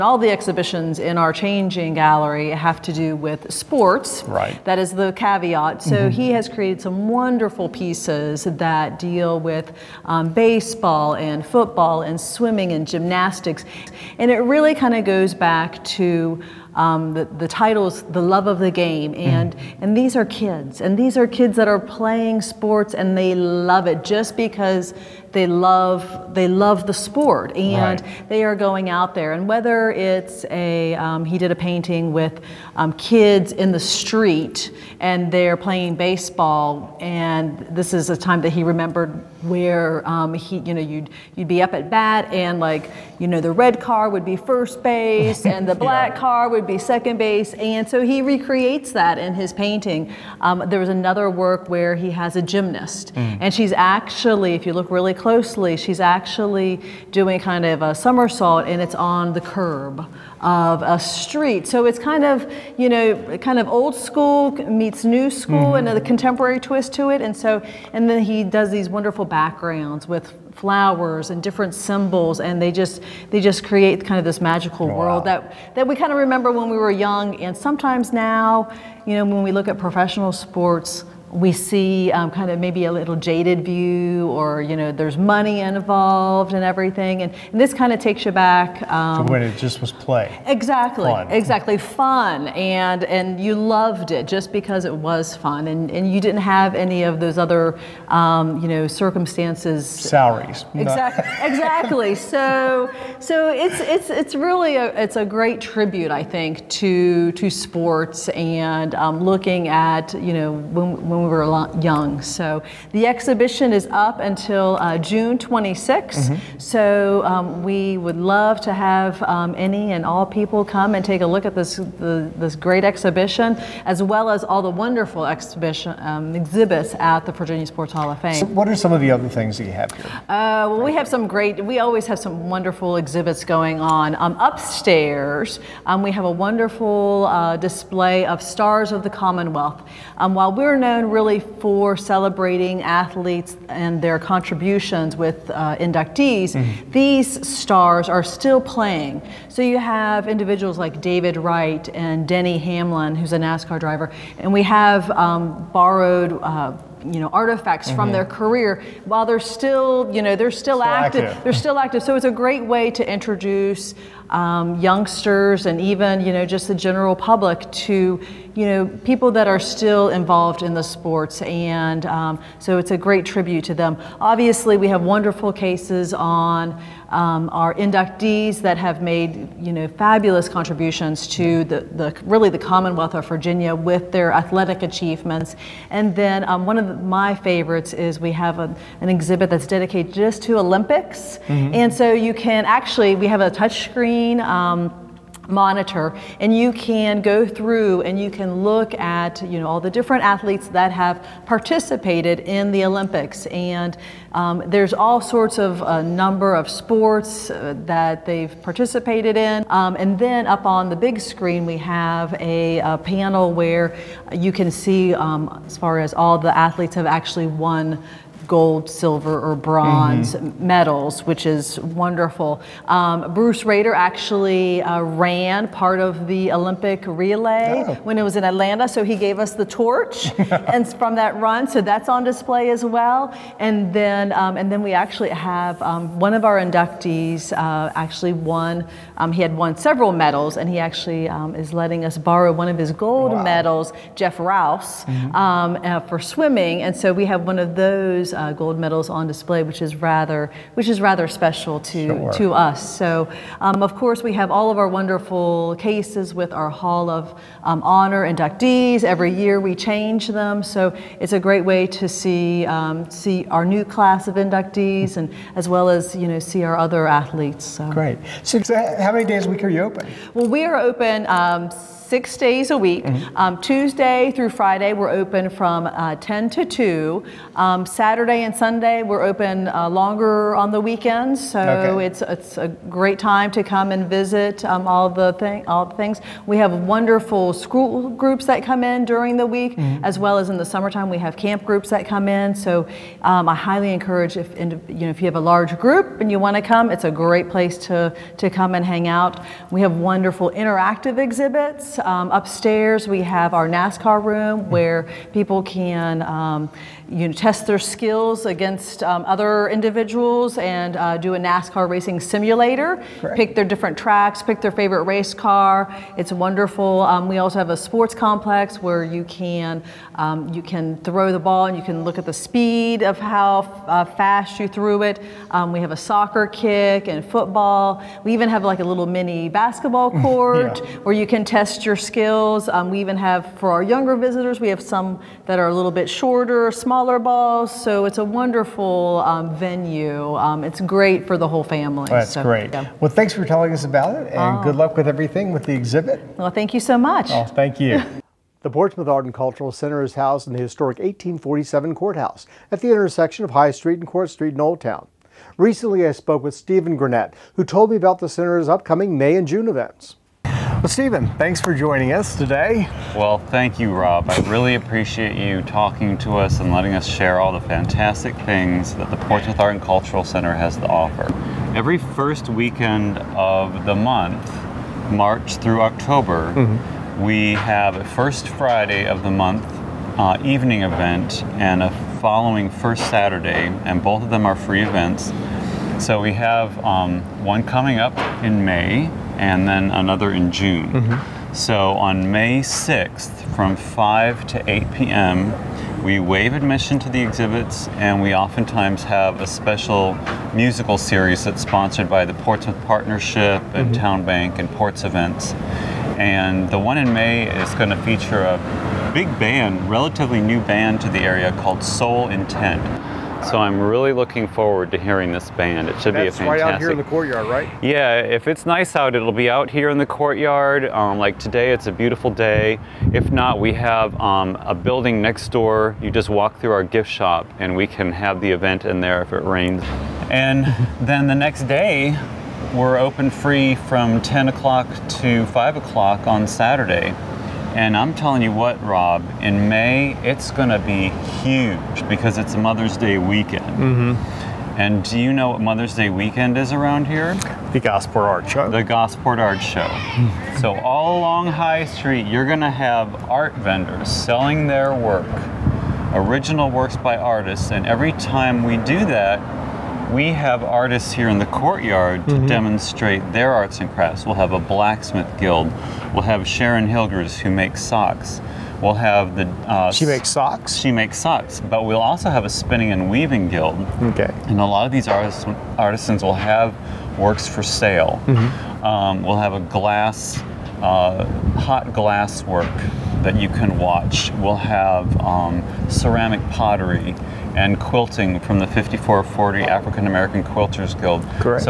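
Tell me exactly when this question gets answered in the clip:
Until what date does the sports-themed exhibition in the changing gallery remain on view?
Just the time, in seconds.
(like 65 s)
114 s.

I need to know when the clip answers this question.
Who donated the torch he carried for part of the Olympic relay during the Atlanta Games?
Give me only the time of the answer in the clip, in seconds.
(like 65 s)
223 s.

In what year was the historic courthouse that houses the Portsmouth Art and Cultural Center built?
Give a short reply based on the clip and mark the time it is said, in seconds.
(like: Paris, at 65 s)
1847, at 350 s.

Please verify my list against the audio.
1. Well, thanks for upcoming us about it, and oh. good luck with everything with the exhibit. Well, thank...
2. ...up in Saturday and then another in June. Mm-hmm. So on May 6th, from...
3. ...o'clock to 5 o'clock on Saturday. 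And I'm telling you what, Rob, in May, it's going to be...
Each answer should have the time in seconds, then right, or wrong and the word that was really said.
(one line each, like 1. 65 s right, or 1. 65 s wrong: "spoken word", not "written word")
1. 342 s wrong: "telling", not "upcoming"
2. 387 s wrong: "May", not "Saturday"
3. 434 s right.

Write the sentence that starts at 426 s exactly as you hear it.
You just walk through our gift shop, and we can have the event in there if it rains.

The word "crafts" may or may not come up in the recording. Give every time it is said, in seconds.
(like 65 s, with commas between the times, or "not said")
463 s.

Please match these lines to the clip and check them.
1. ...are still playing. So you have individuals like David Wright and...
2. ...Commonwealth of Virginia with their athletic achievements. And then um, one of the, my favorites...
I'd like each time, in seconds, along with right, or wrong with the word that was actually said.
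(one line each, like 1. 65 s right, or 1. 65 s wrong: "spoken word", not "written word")
1. 148 s right
2. 182 s right.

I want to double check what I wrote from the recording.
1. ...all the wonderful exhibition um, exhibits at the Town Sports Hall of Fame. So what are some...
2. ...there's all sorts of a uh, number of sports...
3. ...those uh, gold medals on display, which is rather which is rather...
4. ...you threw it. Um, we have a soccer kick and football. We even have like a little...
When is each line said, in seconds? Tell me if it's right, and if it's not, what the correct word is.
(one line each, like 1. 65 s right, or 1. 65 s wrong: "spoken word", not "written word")
1. 124 s wrong: "Virginia", not "Town"
2. 204 s right
3. 247 s right
4. 324 s right.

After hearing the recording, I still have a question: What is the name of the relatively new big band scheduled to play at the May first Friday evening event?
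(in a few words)
Soul Intent.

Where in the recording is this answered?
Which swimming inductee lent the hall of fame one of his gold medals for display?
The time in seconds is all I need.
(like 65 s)
244 s.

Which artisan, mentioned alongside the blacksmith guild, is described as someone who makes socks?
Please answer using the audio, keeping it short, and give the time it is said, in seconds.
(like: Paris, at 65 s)
Sharon Hilgers, at 466 s.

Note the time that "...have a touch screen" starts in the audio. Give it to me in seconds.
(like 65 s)
193 s.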